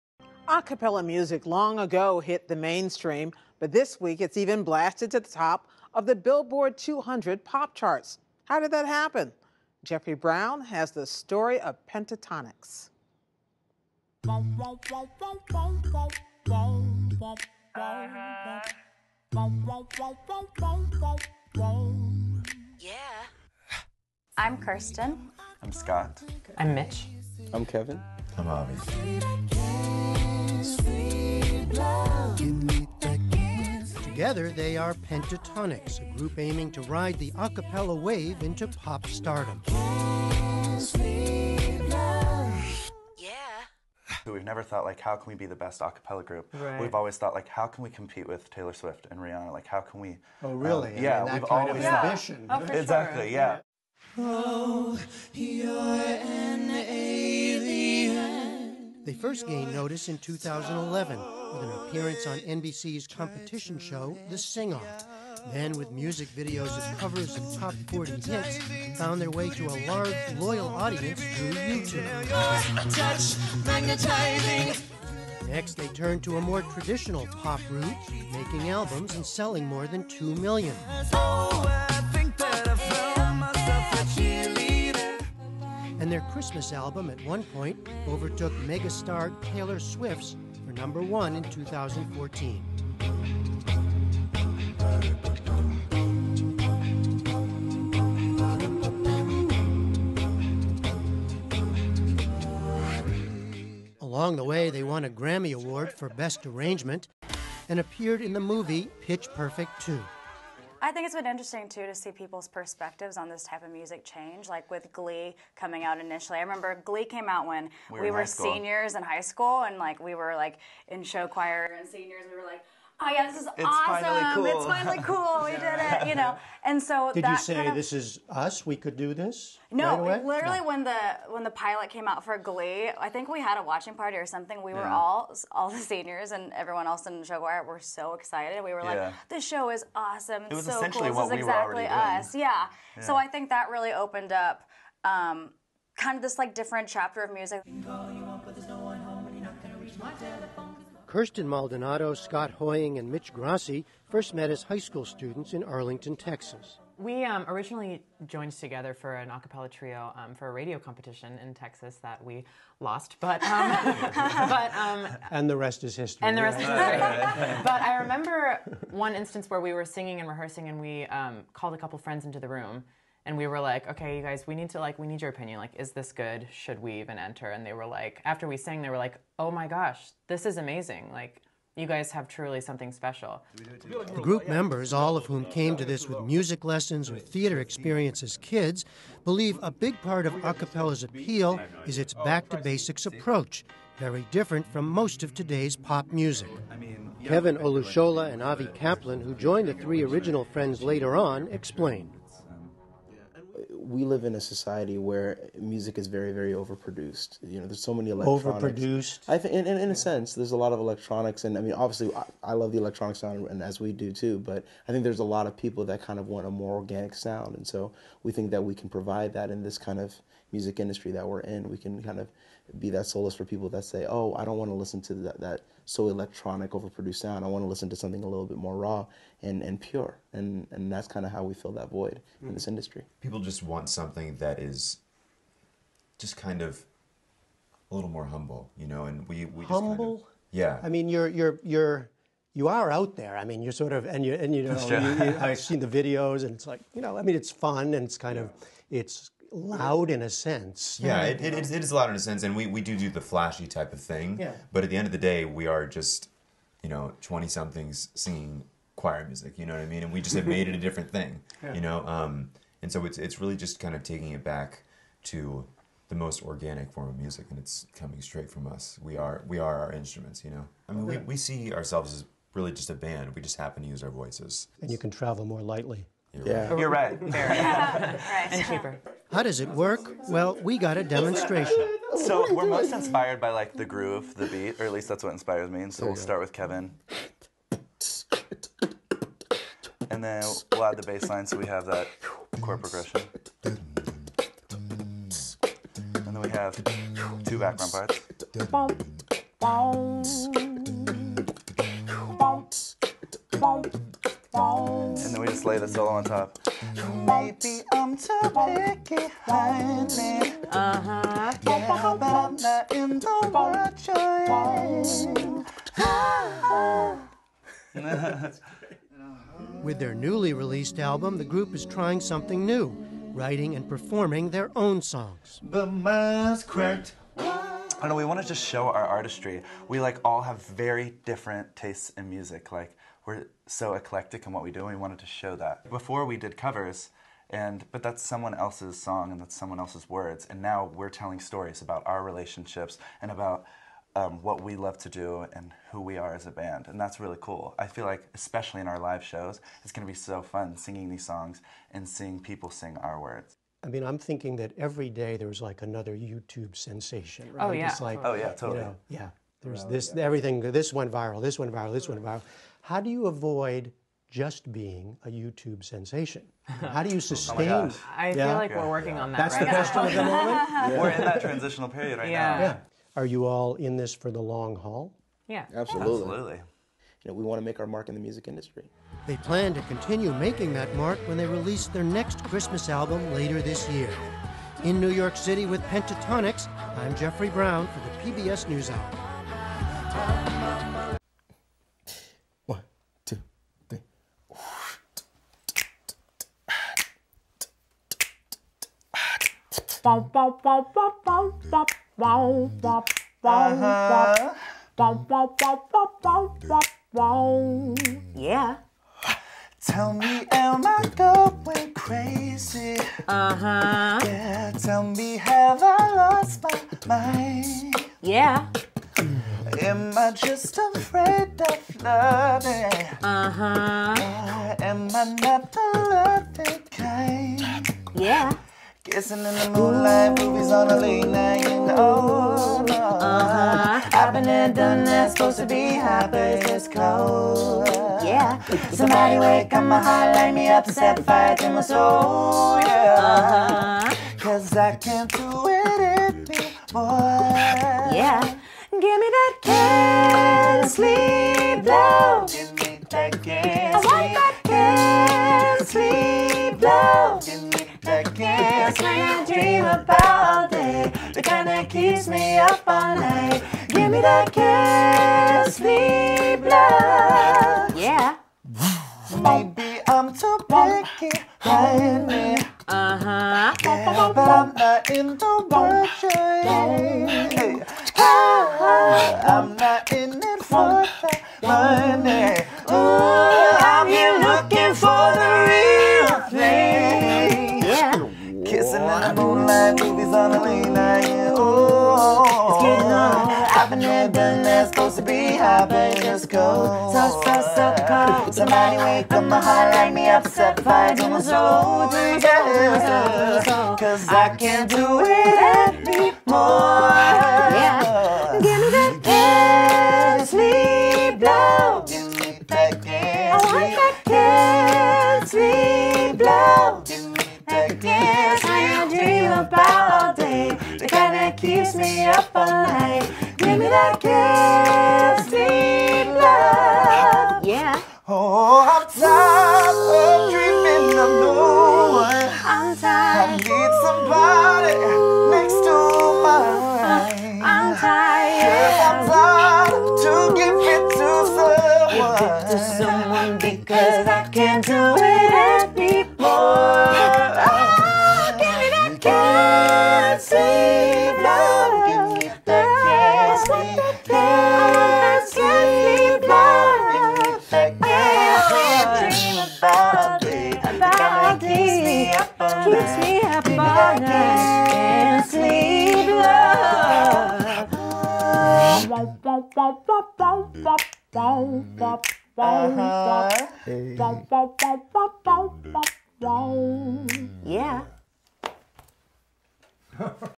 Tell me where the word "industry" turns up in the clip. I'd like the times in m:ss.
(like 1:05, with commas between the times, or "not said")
3:40, 3:52, 6:18.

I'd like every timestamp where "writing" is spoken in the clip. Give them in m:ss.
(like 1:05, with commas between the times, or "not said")
5:23.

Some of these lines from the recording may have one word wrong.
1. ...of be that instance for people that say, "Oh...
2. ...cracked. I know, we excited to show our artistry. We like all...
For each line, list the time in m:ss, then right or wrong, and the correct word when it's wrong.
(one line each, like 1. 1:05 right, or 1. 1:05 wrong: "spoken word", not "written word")
1. 3:42 wrong: "solace", not "instance"
2. 5:26 wrong: "wanted", not "excited".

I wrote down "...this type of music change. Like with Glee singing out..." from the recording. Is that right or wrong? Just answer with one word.
wrong.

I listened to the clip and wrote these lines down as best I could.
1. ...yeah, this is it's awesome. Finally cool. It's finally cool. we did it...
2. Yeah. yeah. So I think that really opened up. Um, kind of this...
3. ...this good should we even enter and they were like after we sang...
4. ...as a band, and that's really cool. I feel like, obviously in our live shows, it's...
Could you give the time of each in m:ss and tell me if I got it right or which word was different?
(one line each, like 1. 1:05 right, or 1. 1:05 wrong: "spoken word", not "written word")
1. 2:03 right
2. 2:22 right
3. 2:55 right
4. 5:46 wrong: "especially", not "obviously".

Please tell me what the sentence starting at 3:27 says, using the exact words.
You know, there's so many electronics.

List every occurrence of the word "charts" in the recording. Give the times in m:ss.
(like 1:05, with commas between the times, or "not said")
0:07.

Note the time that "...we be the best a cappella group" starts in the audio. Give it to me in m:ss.
0:45.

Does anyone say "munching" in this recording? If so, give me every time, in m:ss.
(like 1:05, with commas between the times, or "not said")
not said.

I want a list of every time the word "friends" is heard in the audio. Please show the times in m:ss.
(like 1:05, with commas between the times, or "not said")
2:51, 3:20.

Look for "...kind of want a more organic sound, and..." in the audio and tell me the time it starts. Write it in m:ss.
3:36.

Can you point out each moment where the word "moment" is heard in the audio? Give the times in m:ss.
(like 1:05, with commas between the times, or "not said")
6:10.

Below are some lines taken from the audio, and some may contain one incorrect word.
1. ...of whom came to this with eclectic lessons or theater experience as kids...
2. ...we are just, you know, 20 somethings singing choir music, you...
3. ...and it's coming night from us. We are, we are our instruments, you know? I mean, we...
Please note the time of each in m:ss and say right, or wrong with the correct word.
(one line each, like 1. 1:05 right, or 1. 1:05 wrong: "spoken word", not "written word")
1. 3:05 wrong: "music", not "eclectic"
2. 4:15 right
3. 4:27 wrong: "straight", not "night".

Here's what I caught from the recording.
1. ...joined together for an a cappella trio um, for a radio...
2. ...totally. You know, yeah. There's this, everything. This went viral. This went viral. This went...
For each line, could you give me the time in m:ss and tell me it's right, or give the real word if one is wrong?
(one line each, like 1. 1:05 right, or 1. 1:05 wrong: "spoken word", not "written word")
1. 2:38 right
2. 5:58 right.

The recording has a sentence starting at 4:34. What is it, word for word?
And you can travel more lightly.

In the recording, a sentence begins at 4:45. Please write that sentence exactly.
And so we'll start with Kevin.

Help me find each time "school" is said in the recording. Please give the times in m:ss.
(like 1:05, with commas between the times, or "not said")
1:59, 2:34.